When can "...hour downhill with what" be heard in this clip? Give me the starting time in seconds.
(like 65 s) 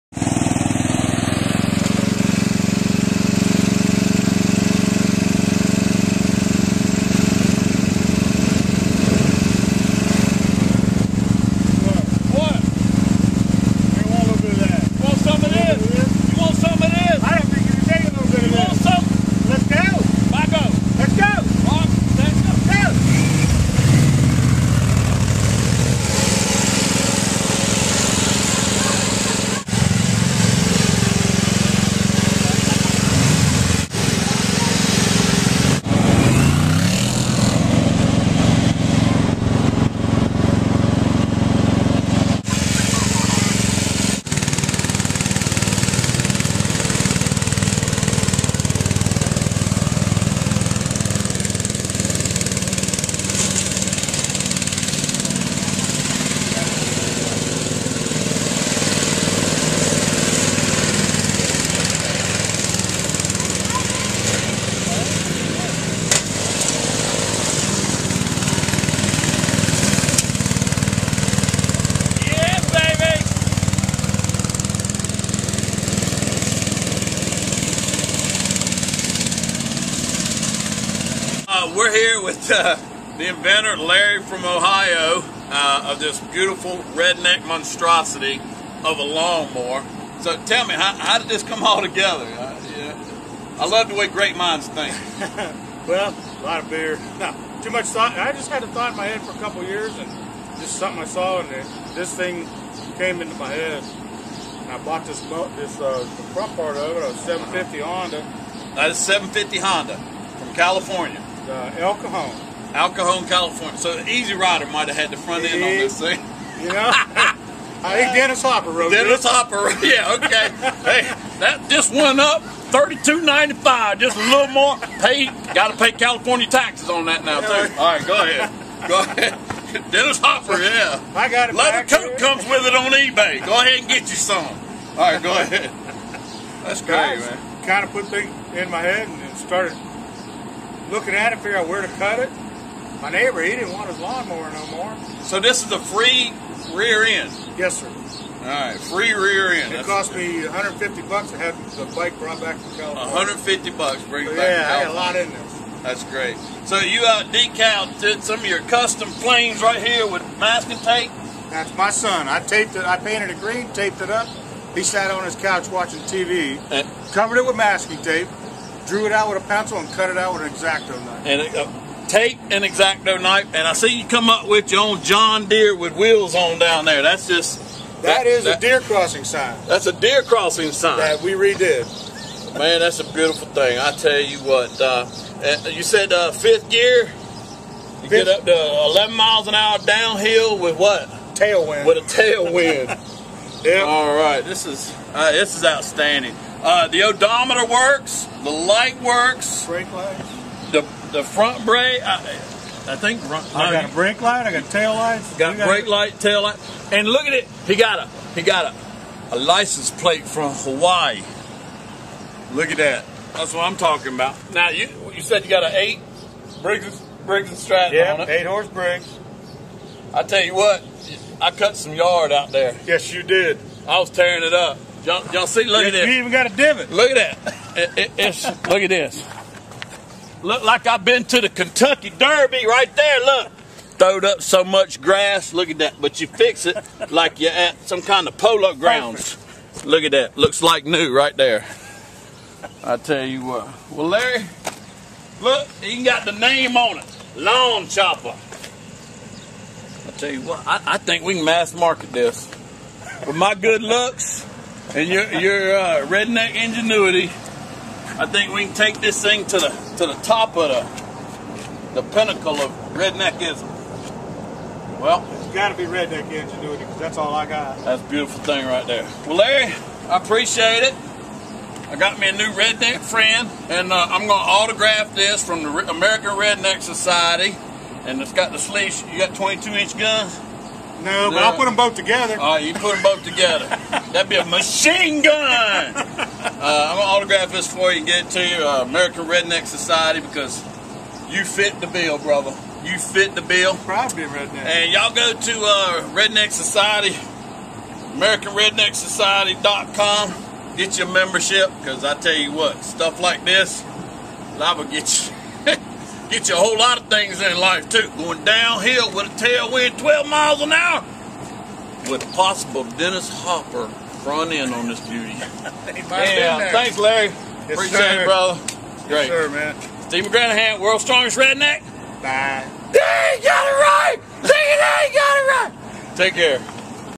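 189 s.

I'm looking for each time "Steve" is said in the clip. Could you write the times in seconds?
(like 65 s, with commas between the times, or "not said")
320 s.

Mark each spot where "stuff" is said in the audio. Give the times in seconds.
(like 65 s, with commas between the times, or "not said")
302 s.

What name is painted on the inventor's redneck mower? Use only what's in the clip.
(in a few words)
Lawn Chopper.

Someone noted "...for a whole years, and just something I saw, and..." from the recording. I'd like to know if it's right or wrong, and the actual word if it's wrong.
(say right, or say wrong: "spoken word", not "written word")
wrong: "couple", not "whole".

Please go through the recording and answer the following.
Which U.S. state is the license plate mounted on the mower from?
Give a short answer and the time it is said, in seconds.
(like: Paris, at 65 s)
Hawaii, at 210 s.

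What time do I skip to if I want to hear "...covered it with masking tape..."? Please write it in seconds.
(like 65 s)
167 s.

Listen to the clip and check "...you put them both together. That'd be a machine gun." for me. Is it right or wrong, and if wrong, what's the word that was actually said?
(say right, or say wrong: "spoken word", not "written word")
right.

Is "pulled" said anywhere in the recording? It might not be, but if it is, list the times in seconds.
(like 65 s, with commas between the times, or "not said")
not said.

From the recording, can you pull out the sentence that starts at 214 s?
Now you you said you got an eight Briggs Briggs and Stratton yeah, on it.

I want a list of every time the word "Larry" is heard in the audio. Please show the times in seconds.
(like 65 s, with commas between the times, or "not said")
83 s, 244 s, 269 s, 316 s.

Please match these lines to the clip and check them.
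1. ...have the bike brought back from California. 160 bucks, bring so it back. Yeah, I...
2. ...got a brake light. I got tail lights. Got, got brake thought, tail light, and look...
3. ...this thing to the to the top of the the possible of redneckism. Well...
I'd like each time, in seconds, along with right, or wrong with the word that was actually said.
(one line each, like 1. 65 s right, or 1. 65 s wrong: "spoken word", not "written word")
1. 151 s wrong: "150", not "160"
2. 203 s wrong: "light", not "thought"
3. 258 s wrong: "pinnacle", not "possible".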